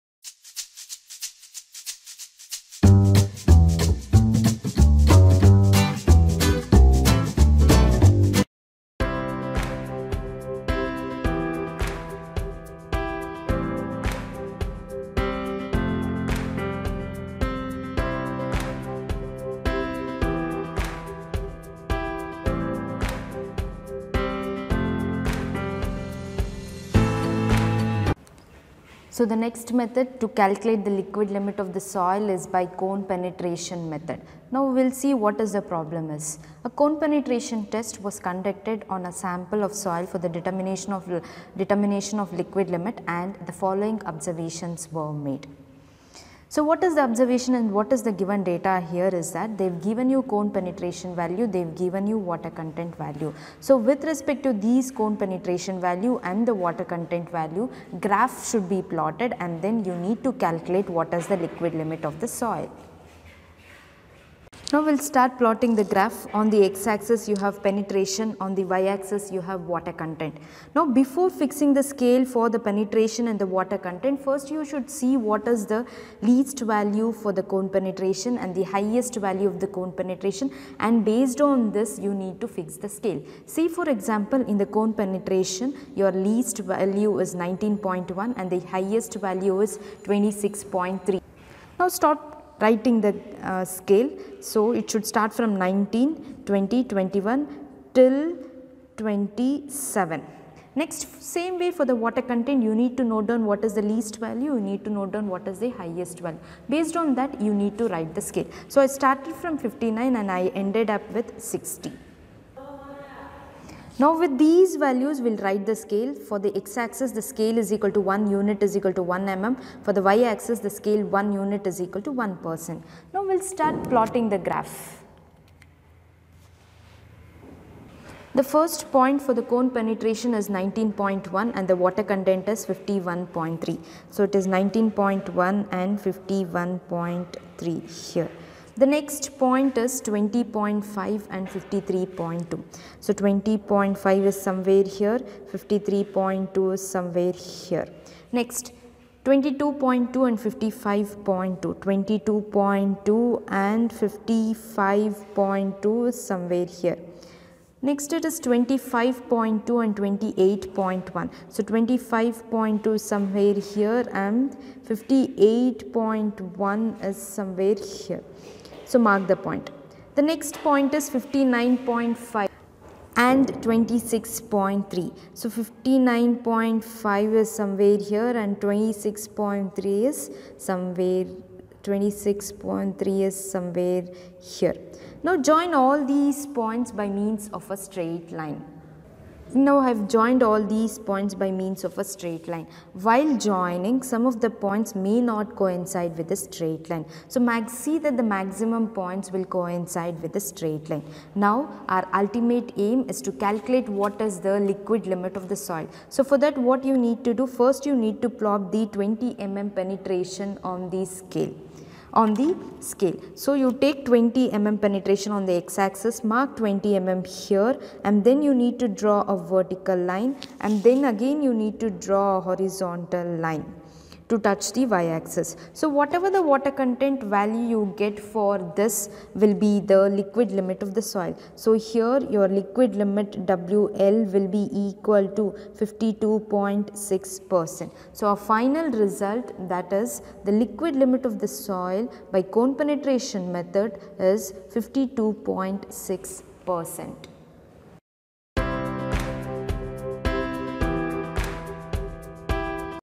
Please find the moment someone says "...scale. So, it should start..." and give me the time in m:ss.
1:33.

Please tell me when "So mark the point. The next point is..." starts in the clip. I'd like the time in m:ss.
2:48.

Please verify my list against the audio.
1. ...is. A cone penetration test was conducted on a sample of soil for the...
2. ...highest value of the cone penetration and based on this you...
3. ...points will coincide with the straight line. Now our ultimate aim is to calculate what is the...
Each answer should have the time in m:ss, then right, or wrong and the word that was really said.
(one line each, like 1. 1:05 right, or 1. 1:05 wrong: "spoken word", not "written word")
1. 0:36 right
2. 1:18 right
3. 3:18 right.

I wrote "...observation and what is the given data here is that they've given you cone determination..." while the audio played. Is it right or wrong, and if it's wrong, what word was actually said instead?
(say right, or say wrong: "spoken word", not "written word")
wrong: "penetration", not "determination".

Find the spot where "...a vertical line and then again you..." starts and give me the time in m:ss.
3:39.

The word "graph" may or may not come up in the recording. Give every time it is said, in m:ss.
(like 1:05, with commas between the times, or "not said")
0:58, 1:05, 2:04.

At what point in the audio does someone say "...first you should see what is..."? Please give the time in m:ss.
1:14.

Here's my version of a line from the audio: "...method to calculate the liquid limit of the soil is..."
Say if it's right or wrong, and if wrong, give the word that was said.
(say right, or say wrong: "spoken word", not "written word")
right.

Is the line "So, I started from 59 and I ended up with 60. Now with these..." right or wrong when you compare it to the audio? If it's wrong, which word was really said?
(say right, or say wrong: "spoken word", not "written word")
right.